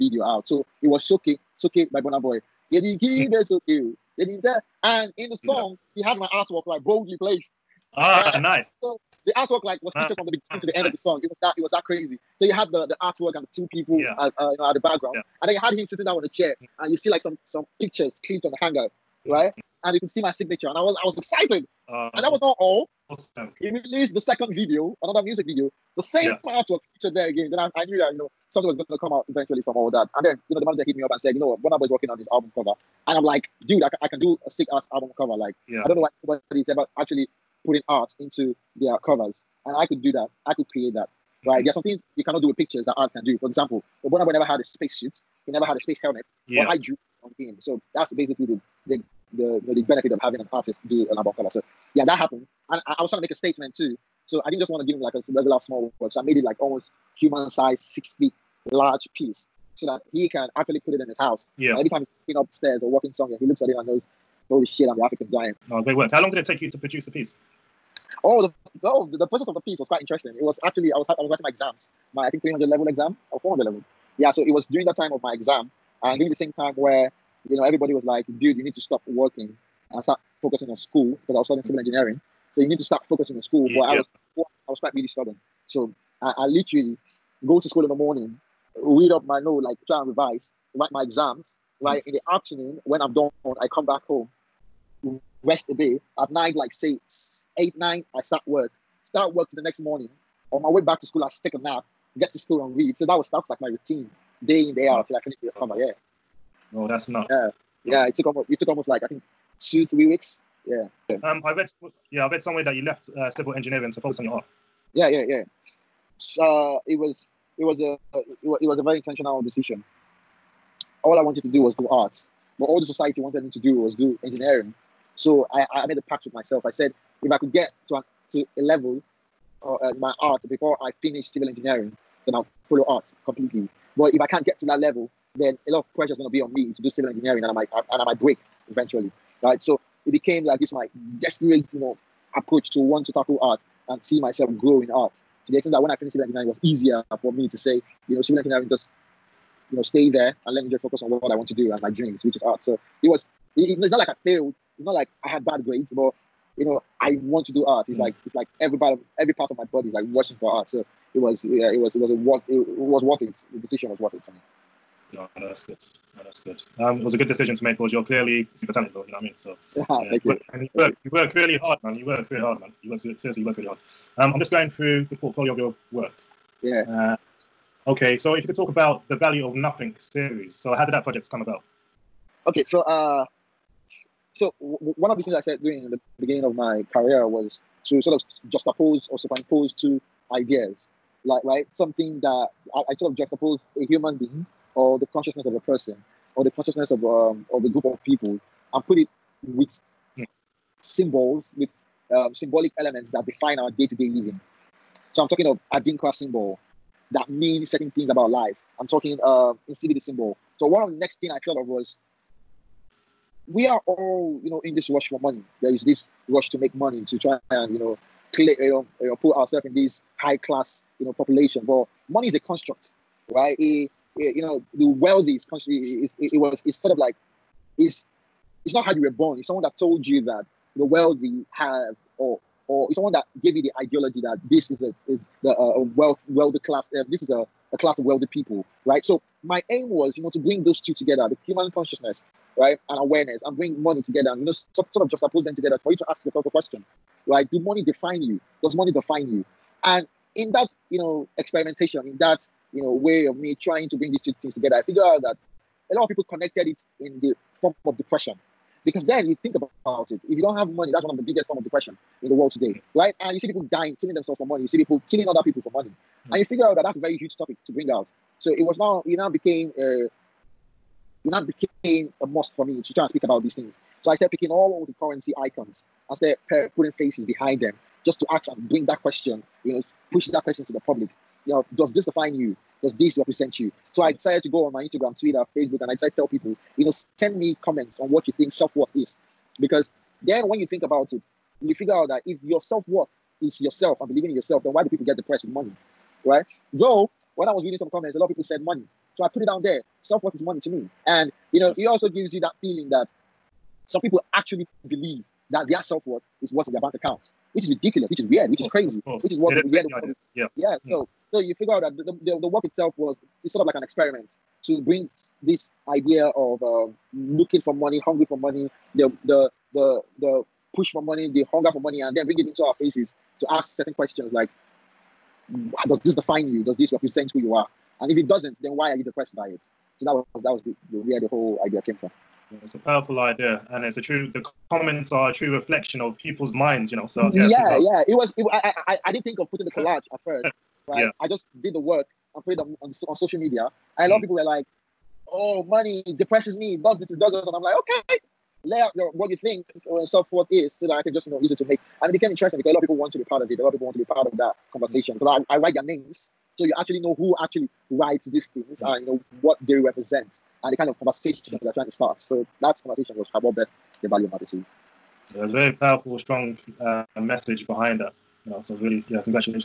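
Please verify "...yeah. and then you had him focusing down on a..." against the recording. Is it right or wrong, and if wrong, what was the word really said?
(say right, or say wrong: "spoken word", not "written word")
wrong: "sitting", not "focusing".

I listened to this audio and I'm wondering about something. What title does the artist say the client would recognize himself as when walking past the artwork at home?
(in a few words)
The African giant.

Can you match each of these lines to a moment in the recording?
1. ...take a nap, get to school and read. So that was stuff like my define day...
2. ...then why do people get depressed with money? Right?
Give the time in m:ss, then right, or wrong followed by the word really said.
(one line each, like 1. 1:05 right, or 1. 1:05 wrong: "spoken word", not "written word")
1. 1:41 wrong: "routine", not "define"
2. 4:54 right.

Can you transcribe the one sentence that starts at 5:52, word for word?
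And it became interesting because a lot of people want to be part of it.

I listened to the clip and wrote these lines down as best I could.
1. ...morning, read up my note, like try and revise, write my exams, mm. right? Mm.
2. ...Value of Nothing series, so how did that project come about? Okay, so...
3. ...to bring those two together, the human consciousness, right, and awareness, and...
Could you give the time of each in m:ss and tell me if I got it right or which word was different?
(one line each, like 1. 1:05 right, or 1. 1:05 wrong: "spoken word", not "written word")
1. 1:27 right
2. 2:59 right
3. 4:00 right.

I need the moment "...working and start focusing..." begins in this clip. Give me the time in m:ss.
1:19.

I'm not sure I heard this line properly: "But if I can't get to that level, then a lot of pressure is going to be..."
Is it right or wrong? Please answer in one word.
right.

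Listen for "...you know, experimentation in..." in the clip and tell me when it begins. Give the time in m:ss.
4:10.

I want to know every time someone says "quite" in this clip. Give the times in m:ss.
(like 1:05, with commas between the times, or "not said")
1:09, 1:24.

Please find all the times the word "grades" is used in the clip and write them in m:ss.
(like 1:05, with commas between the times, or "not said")
2:35.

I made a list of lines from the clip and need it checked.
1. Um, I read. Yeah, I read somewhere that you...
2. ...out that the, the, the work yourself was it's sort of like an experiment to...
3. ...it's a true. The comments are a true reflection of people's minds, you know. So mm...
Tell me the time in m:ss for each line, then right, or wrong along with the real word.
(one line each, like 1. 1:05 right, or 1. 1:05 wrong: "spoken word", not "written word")
1. 1:51 right
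2. 5:11 wrong: "itself", not "yourself"
3. 5:33 right.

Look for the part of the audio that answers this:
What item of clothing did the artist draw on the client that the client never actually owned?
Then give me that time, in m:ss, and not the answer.
0:44.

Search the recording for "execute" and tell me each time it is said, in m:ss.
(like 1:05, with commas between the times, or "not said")
not said.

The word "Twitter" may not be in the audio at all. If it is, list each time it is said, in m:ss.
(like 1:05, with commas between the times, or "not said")
4:45.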